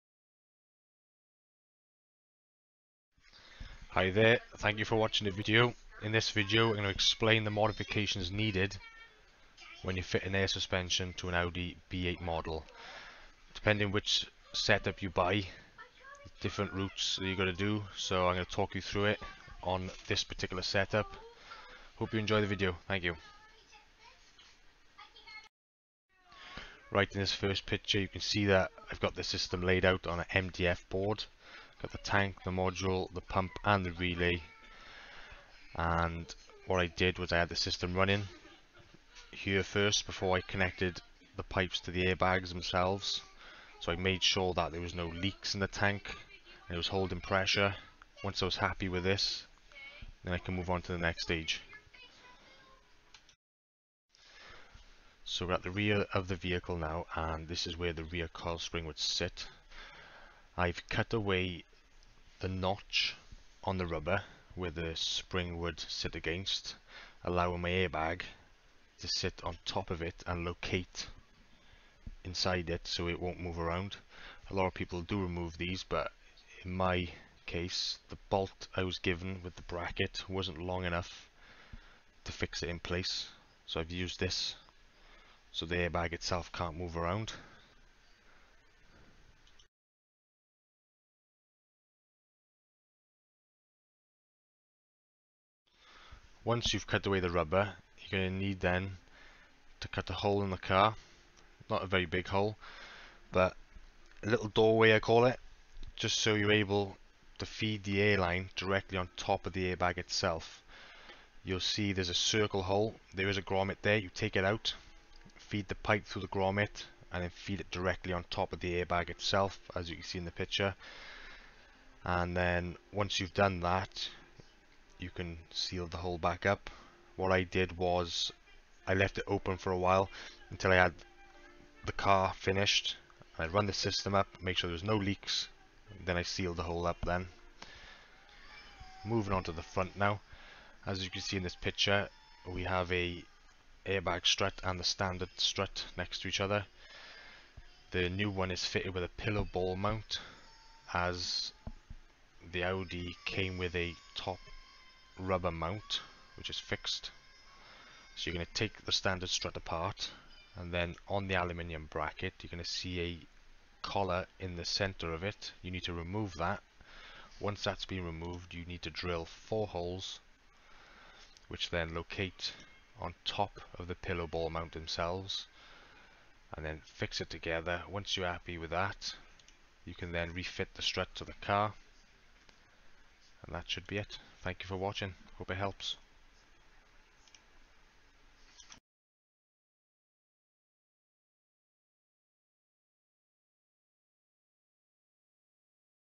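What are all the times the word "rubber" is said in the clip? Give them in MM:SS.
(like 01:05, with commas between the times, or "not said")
01:03, 01:37, 02:35.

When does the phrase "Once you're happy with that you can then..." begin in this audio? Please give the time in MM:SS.
02:57.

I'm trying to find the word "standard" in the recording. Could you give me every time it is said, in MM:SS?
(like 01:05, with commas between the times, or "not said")
02:24, 02:38.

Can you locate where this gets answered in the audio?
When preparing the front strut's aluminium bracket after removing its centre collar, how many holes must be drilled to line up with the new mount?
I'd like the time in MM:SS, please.
02:49.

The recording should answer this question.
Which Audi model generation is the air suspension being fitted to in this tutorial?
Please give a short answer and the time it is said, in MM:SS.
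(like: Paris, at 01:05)
B8, at 00:11.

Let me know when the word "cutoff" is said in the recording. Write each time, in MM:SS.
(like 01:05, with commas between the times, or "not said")
not said.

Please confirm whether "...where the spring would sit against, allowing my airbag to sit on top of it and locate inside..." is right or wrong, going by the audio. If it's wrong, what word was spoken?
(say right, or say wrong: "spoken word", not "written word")
right.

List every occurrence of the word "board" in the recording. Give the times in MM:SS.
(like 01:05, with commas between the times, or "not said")
00:30.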